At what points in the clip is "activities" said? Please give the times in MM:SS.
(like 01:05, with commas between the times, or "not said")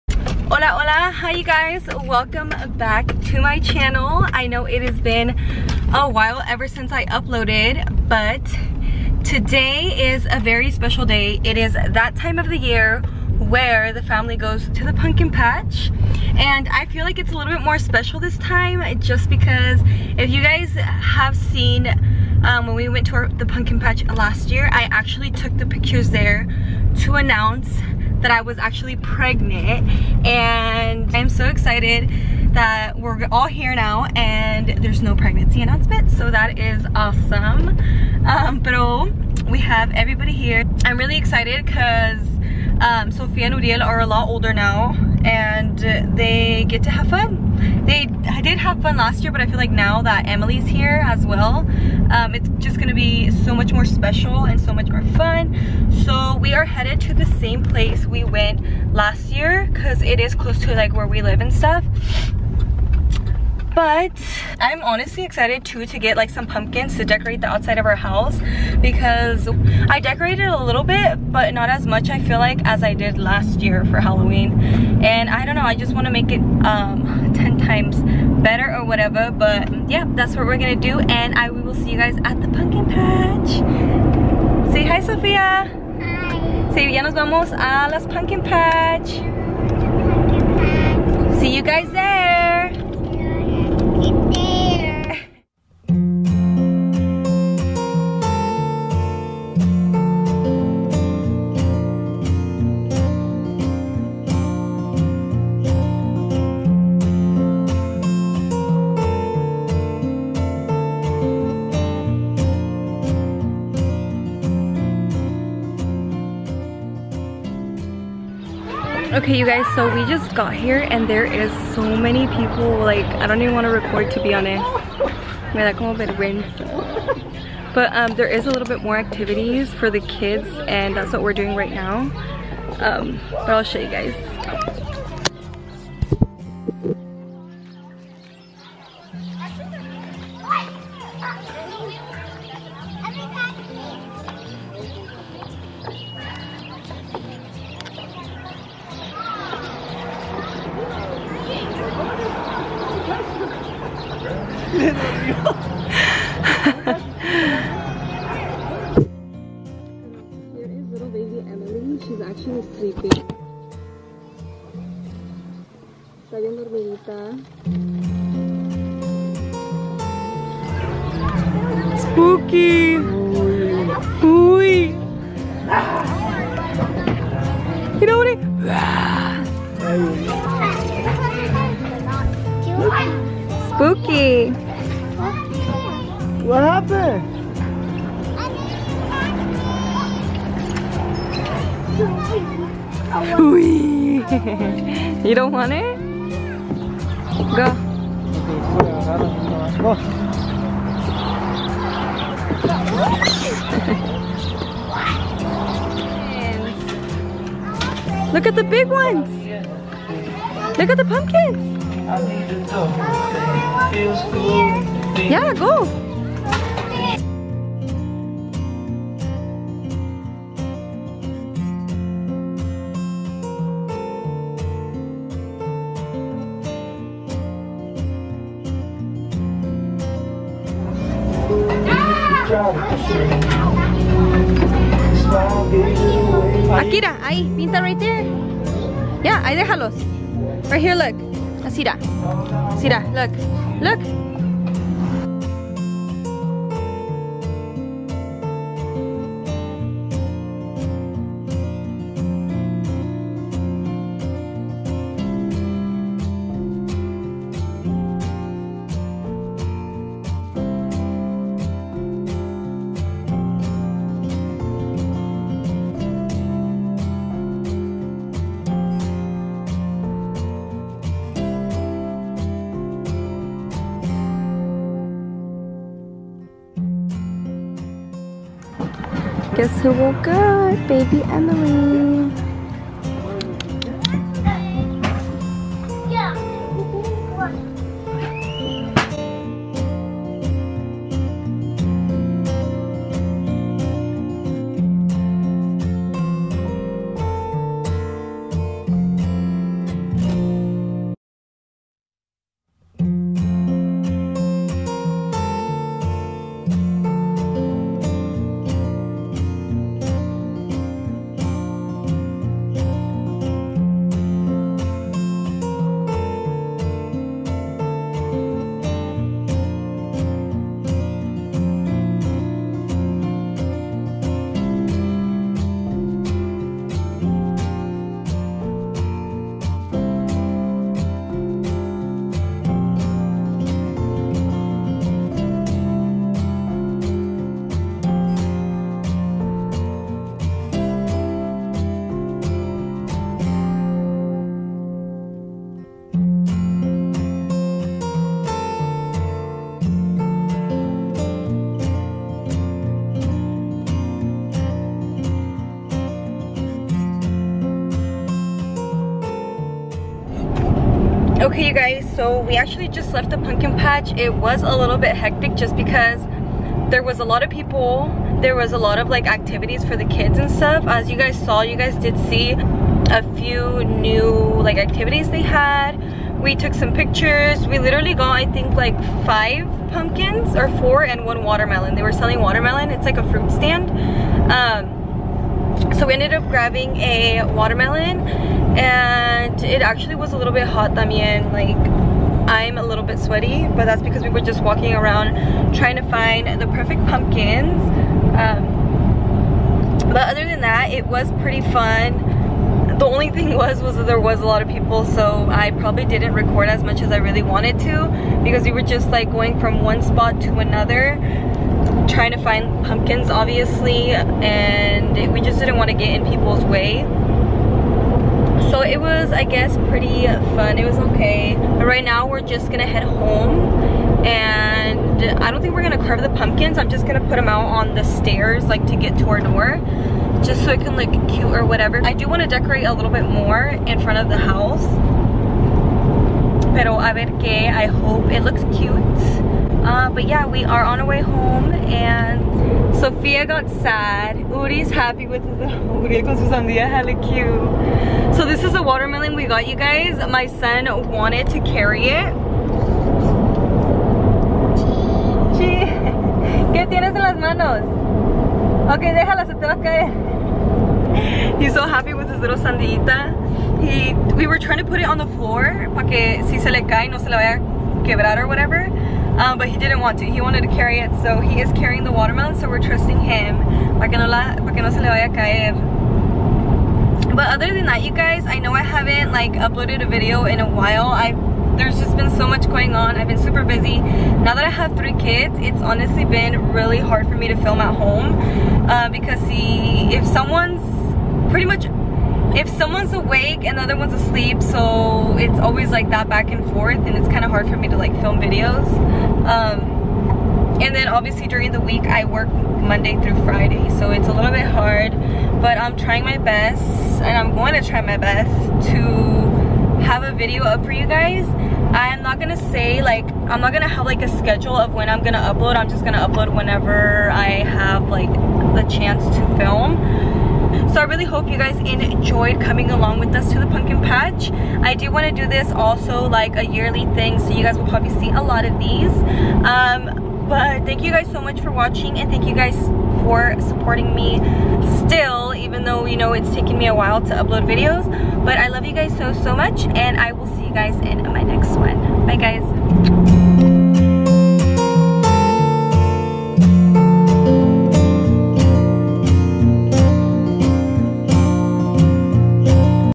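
02:08, 06:09, 06:14.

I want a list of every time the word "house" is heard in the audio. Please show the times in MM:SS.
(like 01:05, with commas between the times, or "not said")
01:07, 07:14.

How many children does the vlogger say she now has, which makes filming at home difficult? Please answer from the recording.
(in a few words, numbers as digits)
3.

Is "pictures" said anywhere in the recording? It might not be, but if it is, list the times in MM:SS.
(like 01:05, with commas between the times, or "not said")
00:25, 06:16.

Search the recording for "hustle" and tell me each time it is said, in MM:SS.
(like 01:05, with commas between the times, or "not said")
not said.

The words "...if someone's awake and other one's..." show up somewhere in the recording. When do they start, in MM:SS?
08:12.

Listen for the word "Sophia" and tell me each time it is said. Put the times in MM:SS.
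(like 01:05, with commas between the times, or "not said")
00:43, 07:22.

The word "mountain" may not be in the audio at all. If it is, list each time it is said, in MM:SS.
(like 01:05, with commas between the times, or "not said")
not said.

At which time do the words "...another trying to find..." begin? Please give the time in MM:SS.
06:50.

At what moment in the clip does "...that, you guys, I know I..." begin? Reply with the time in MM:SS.
07:57.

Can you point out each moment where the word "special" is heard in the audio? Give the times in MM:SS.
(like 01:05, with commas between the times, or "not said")
00:10, 00:17, 00:53.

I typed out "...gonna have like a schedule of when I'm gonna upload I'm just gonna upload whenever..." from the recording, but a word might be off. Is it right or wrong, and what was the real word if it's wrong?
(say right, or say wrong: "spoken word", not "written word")
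right.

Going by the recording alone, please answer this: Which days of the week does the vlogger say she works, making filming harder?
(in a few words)
Monday through Friday.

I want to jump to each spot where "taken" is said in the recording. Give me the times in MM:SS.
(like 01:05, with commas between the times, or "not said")
08:56.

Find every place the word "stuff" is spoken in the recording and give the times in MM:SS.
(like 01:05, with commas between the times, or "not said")
01:01, 06:10.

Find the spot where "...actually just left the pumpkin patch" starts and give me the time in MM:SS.
06:02.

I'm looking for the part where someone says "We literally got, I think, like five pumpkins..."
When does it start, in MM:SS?
06:17.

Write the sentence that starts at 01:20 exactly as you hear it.
And I we will see you guys at the pumpkin patch.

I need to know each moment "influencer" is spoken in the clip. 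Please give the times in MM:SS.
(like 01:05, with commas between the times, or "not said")
not said.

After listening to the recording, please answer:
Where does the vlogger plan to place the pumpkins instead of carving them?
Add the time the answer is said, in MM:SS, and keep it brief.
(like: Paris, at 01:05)
On the stairs, at 07:07.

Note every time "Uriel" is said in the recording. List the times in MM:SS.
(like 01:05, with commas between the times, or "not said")
00:43.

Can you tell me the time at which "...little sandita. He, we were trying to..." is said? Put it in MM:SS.
07:42.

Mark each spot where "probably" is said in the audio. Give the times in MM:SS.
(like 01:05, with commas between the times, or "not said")
06:45, 08:47.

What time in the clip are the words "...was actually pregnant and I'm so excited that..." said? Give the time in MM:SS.
00:28.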